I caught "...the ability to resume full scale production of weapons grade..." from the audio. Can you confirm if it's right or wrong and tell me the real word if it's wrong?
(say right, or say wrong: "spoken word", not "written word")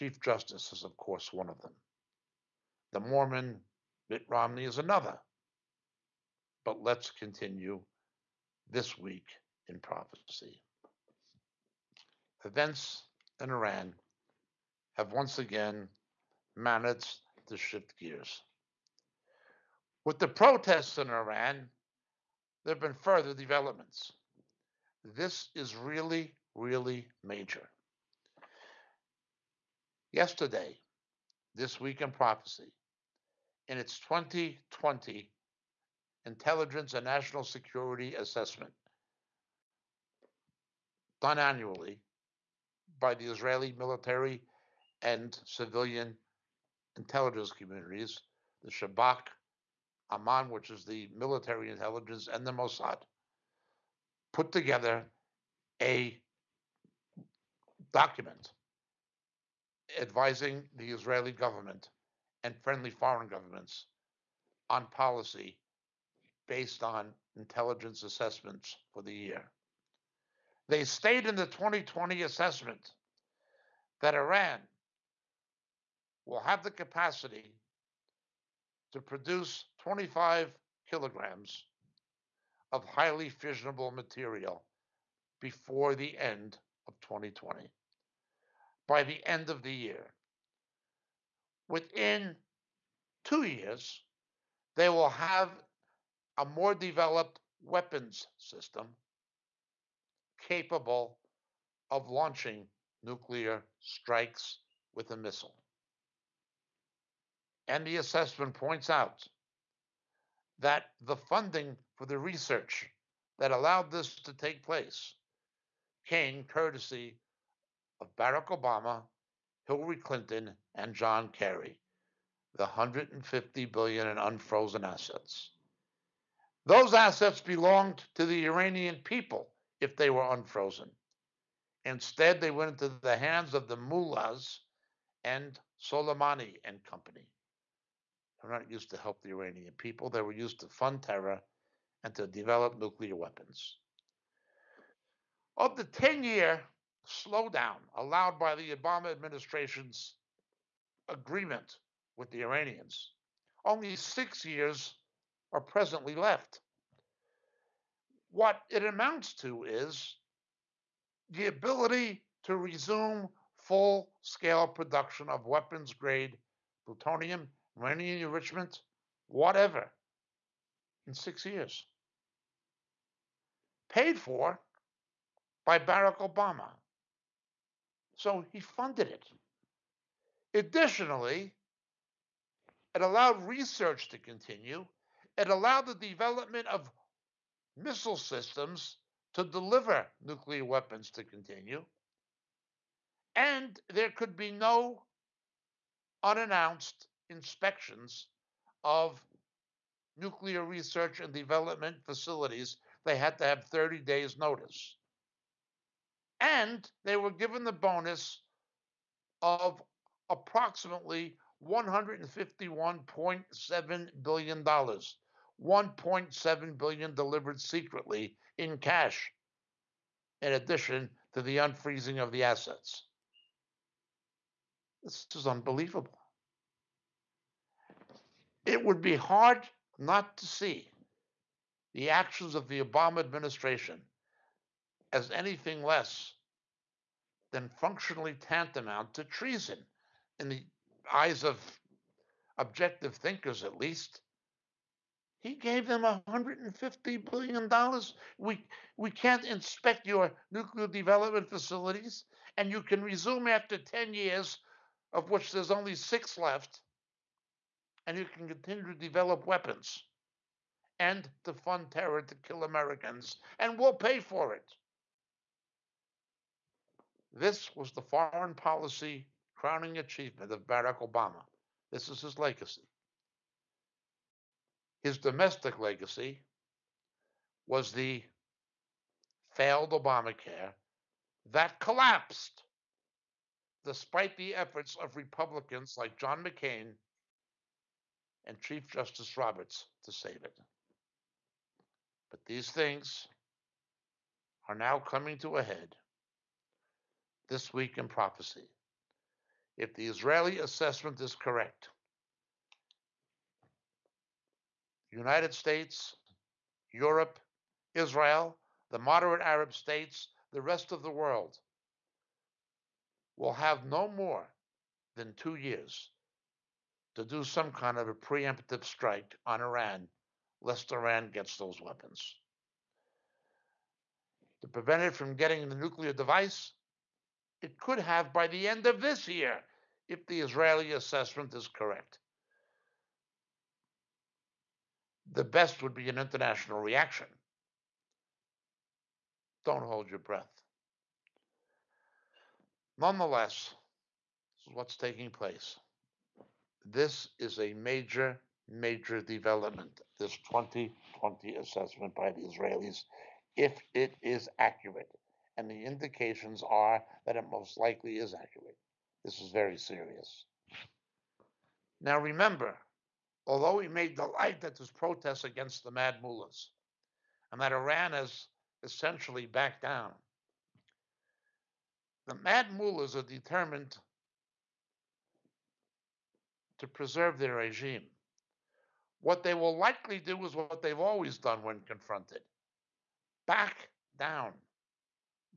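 right.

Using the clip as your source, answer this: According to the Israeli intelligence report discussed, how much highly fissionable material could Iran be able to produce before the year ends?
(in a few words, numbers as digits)
25 kilograms.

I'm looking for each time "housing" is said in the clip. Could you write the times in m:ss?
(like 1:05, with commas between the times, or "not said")
not said.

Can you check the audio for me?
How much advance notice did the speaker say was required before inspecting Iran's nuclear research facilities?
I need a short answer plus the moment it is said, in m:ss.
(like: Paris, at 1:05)
30 days, at 3:23.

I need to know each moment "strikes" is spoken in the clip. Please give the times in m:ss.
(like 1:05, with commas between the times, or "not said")
1:43, 5:18.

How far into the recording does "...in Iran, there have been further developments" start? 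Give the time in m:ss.
0:20.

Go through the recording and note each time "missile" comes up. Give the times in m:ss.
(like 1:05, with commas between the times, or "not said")
1:45, 3:07.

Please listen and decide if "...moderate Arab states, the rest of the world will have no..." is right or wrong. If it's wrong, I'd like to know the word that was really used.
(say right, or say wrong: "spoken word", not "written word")
right.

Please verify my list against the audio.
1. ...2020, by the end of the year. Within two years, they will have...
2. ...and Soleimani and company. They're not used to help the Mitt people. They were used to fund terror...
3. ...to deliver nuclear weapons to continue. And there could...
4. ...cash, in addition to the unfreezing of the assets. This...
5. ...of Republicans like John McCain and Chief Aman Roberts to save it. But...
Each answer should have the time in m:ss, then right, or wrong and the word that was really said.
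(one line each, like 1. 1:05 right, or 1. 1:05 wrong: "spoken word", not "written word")
1. 1:27 right
2. 2:15 wrong: "Iranian", not "Mitt"
3. 3:09 right
4. 3:38 right
5. 4:45 wrong: "Justice", not "Aman".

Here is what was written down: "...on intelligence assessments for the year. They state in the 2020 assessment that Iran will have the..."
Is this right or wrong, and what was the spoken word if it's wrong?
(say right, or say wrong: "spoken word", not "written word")
right.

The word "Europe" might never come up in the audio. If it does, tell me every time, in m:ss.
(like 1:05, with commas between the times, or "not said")
5:06.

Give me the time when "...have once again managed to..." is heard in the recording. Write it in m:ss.
0:14.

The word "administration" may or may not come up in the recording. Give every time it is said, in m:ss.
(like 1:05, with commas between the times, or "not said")
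2:29, 3:53.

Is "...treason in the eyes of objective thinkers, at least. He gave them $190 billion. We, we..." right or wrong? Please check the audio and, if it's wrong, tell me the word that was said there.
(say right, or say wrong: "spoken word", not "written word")
wrong: "150", not "190".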